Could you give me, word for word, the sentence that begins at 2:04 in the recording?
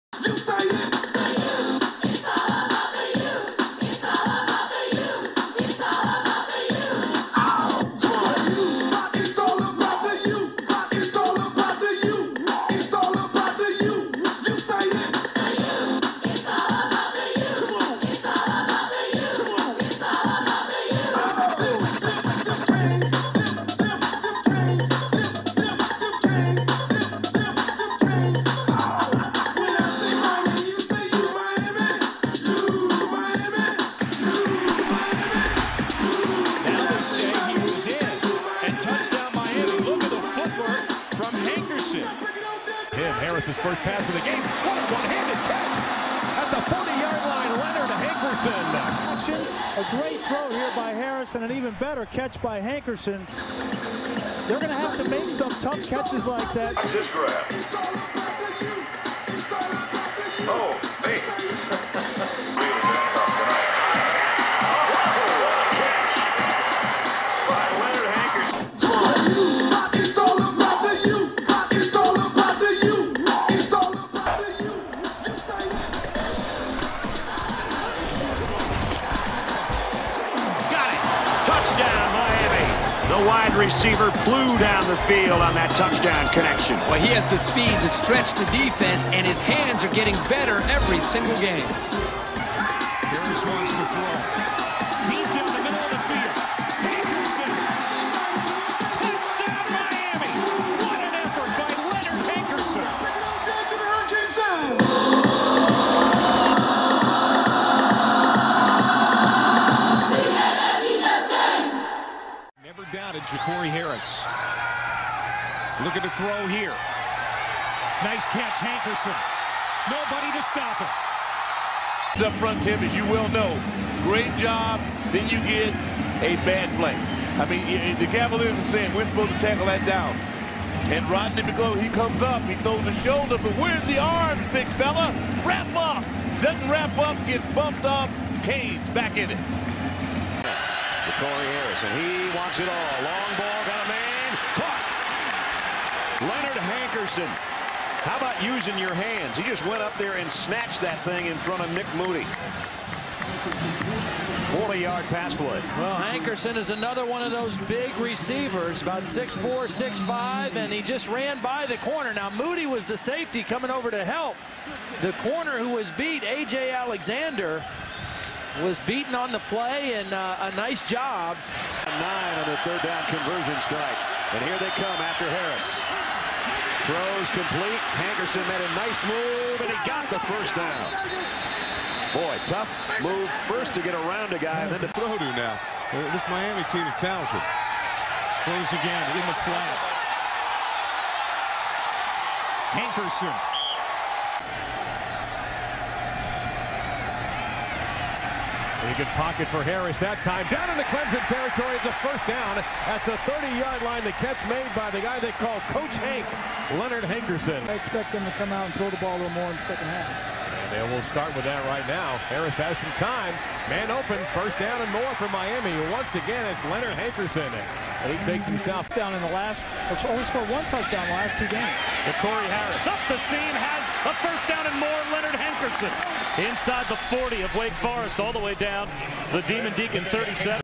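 Great job, then you get a bad play.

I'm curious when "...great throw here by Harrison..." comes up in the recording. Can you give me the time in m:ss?
0:50.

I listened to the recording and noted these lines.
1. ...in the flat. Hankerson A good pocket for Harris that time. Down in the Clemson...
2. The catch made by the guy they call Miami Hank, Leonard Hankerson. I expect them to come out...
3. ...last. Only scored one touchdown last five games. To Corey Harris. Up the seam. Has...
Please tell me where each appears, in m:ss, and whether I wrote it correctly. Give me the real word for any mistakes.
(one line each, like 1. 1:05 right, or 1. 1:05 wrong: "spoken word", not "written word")
1. 3:09 right
2. 3:24 wrong: "Coach", not "Miami"
3. 3:39 wrong: "two", not "five".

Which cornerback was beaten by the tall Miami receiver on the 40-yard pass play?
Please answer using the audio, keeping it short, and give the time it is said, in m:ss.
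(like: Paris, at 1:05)
A.J. Alexander, at 2:46.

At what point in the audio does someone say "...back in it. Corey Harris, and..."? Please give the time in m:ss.
2:18.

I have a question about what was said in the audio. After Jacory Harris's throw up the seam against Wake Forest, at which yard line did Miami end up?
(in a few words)
37.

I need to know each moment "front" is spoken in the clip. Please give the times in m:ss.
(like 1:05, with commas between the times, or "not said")
2:02, 2:31.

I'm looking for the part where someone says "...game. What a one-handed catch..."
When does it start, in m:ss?
0:44.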